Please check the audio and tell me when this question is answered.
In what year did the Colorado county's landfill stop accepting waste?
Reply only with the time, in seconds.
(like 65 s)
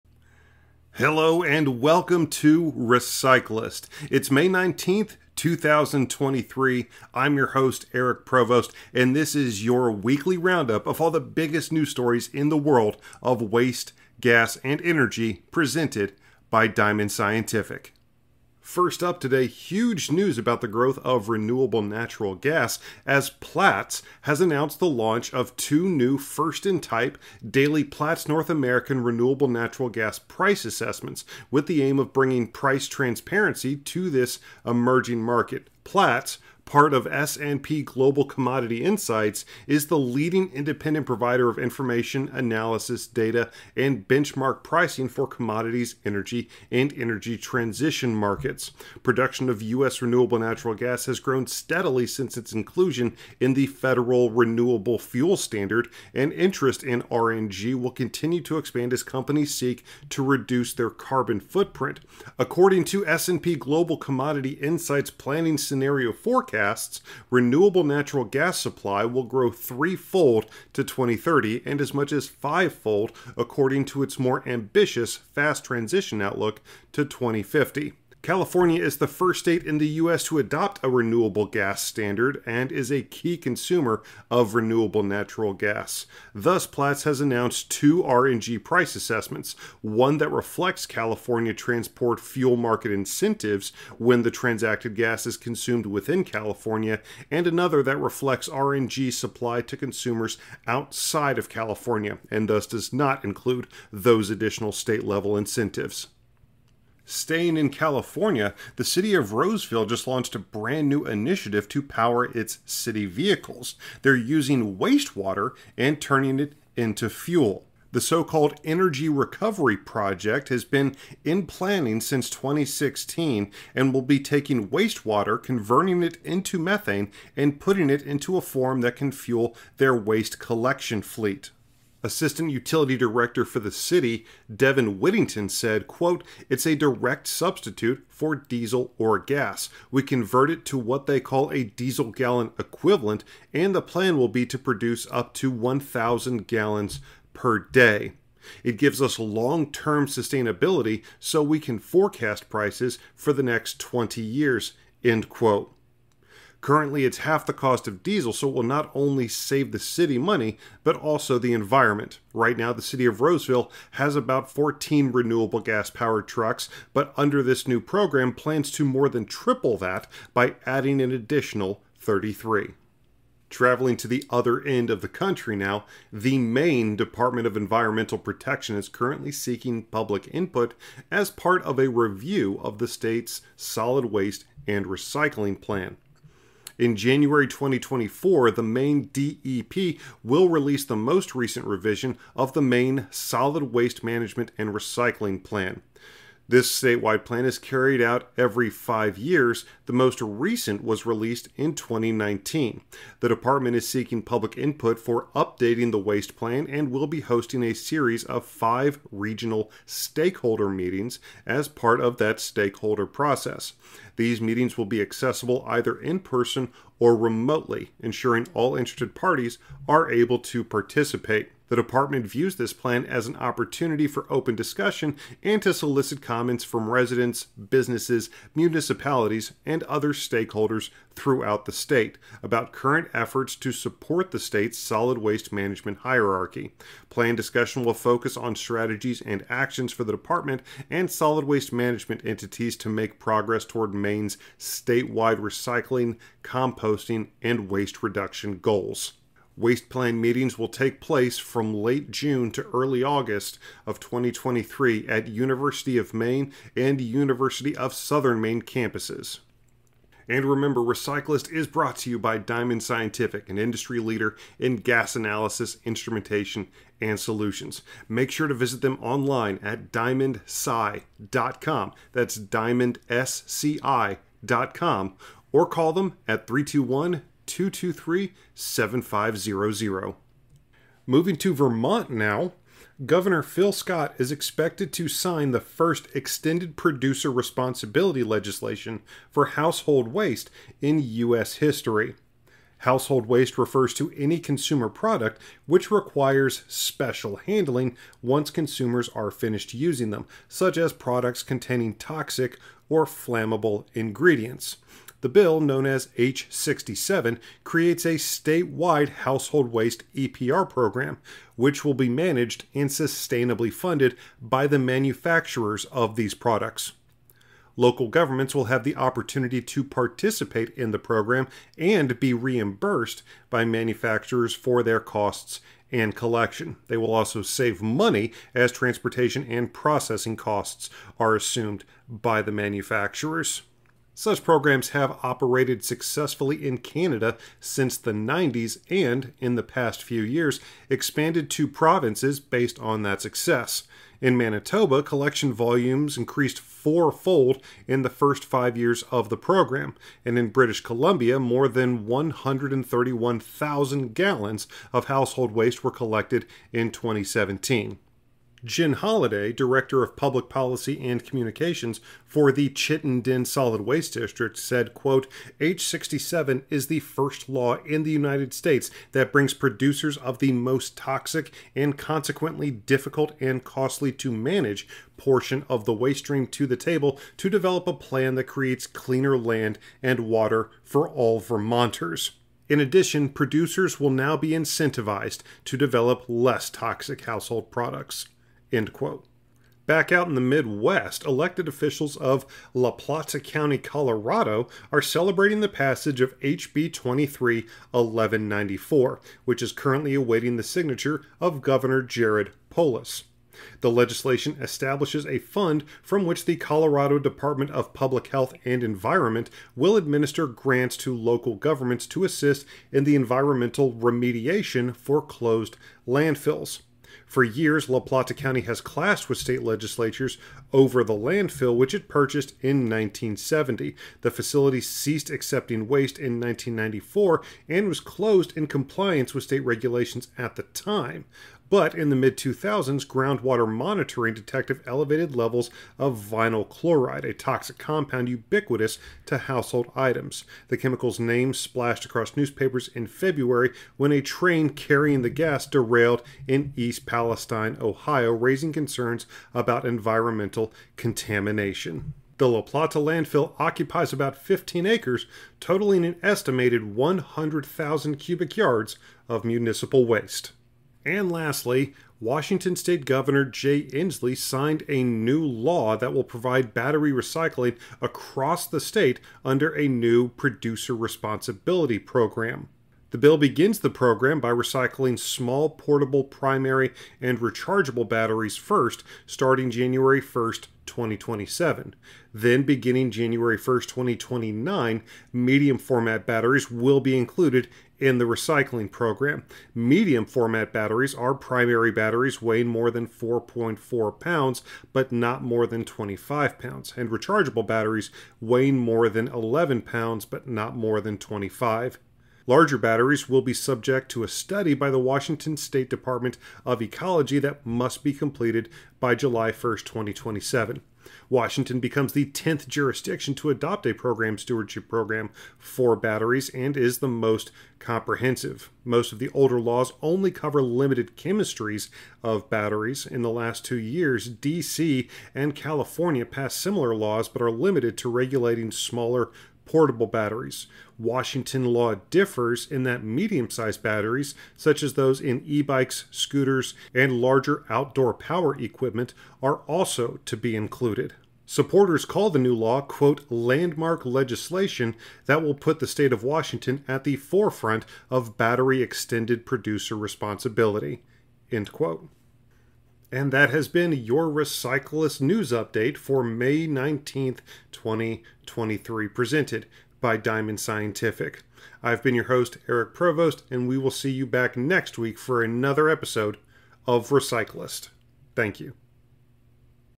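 426 s.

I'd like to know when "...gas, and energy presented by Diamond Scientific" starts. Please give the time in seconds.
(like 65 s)
14 s.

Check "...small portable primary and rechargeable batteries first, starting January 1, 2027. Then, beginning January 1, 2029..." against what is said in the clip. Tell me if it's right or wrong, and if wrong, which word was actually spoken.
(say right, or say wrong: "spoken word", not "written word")
right.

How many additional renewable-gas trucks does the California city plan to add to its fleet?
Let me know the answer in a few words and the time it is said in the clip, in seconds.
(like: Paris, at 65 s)
33, at 171 s.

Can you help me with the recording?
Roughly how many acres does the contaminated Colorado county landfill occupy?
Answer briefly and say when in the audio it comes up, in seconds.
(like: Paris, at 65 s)
15, at 454 s.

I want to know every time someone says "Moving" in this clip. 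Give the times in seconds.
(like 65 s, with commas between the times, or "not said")
281 s.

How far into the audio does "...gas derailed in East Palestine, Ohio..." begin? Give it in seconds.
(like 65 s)
445 s.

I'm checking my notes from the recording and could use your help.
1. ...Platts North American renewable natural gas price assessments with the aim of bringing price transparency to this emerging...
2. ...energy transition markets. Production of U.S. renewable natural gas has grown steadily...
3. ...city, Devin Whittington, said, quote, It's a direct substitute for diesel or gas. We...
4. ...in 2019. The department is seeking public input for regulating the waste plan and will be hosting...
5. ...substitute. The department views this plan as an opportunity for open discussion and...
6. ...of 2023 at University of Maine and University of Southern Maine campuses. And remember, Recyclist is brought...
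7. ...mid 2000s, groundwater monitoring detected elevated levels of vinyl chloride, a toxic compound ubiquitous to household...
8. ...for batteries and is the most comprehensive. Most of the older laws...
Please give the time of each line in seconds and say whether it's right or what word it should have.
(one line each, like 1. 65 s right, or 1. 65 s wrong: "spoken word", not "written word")
1. 27 s right
2. 46 s right
3. 133 s right
4. 201 s wrong: "updating", not "regulating"
5. 220 s wrong: "participate", not "substitute"
6. 253 s right
7. 432 s right
8. 515 s right.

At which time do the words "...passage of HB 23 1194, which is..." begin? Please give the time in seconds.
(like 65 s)
395 s.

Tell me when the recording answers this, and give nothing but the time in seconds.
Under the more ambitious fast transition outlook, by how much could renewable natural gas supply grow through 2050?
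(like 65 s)
72 s.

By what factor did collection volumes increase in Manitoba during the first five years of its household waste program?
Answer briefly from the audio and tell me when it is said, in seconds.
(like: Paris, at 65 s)
fourfold, at 346 s.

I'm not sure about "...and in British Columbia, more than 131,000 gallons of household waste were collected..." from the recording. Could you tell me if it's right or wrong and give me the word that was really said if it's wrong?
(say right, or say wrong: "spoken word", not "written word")
right.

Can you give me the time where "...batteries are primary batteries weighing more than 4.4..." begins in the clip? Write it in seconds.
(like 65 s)
490 s.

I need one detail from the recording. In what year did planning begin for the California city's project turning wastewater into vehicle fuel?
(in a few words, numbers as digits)
2016.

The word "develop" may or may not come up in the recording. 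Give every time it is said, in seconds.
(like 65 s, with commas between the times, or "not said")
377 s, 385 s.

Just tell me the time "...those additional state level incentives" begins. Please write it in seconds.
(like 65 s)
103 s.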